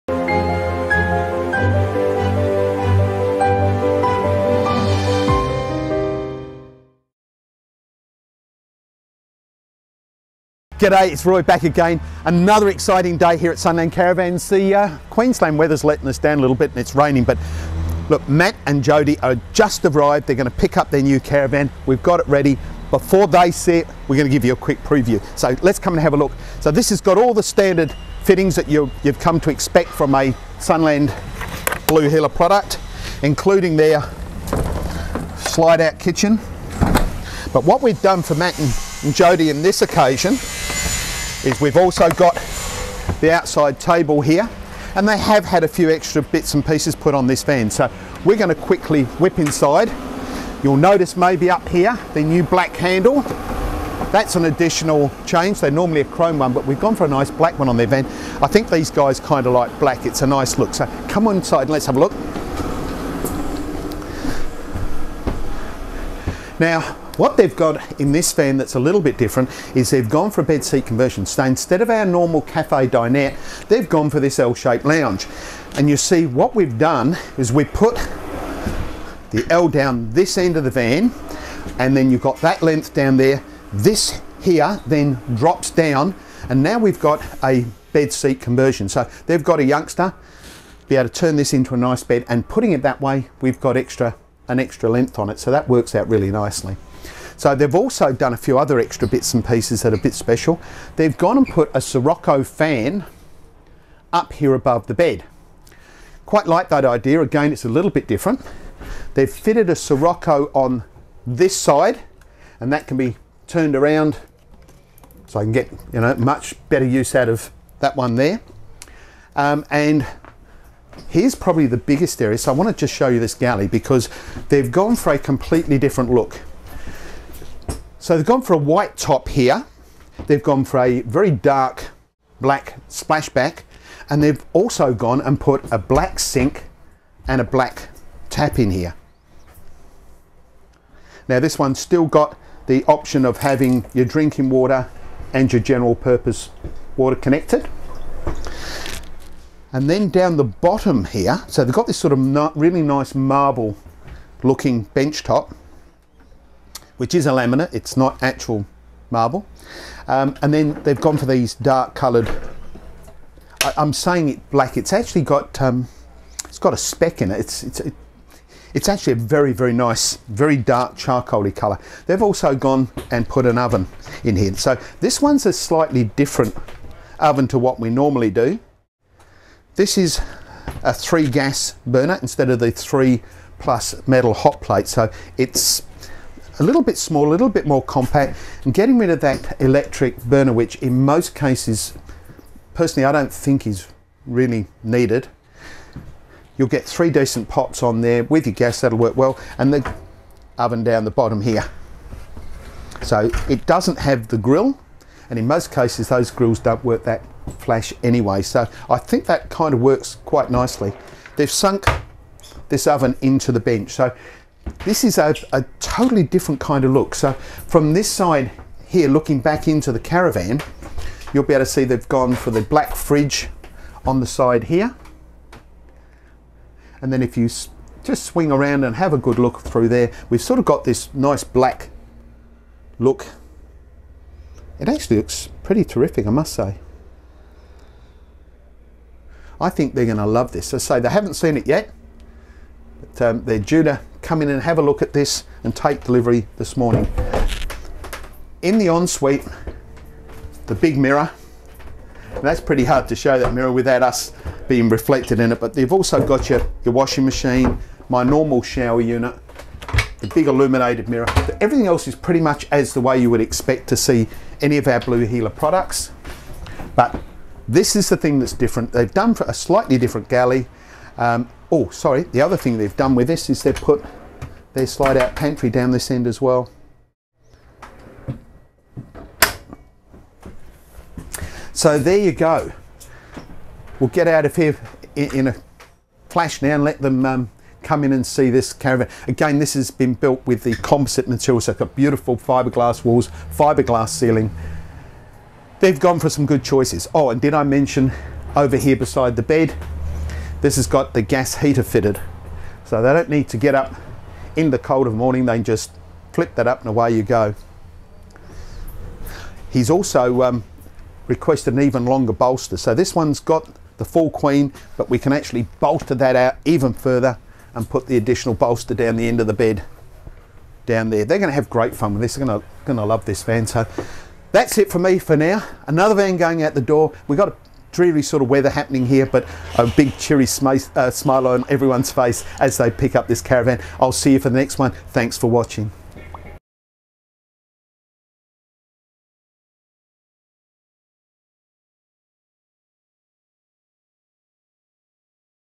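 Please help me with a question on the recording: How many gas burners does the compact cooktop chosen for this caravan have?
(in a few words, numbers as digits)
3.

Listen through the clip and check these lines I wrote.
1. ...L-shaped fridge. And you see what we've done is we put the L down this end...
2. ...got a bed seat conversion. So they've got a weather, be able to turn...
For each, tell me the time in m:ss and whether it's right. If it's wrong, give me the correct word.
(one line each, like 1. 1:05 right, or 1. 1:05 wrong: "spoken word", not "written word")
1. 1:14 wrong: "lounge", not "fridge"
2. 1:26 wrong: "youngster", not "weather".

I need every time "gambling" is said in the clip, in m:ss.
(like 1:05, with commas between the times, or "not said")
not said.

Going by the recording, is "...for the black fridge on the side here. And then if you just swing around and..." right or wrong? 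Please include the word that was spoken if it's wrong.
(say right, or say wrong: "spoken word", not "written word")
right.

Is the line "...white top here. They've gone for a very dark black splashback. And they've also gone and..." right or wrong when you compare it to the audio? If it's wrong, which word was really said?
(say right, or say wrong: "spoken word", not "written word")
right.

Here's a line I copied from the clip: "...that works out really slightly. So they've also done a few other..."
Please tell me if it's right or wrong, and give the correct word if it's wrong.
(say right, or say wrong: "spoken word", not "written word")
wrong: "nicely", not "slightly".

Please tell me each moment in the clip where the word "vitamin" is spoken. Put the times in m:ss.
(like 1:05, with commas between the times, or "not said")
not said.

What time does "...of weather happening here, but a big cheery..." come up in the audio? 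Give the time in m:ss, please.
5:28.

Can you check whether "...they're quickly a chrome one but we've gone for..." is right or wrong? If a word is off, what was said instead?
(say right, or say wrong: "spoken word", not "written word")
wrong: "normally", not "quickly".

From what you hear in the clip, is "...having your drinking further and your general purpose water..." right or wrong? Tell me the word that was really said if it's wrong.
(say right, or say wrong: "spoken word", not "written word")
wrong: "water", not "further".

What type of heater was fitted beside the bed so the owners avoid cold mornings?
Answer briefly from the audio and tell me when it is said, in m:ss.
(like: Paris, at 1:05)
Gas heater, at 5:01.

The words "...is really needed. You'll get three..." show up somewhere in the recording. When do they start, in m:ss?
3:13.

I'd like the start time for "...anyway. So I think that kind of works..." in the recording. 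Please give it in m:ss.
3:28.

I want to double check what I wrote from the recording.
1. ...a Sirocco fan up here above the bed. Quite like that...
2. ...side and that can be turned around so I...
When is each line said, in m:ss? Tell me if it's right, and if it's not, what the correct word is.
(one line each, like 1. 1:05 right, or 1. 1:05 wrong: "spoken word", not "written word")
1. 1:41 right
2. 1:51 right.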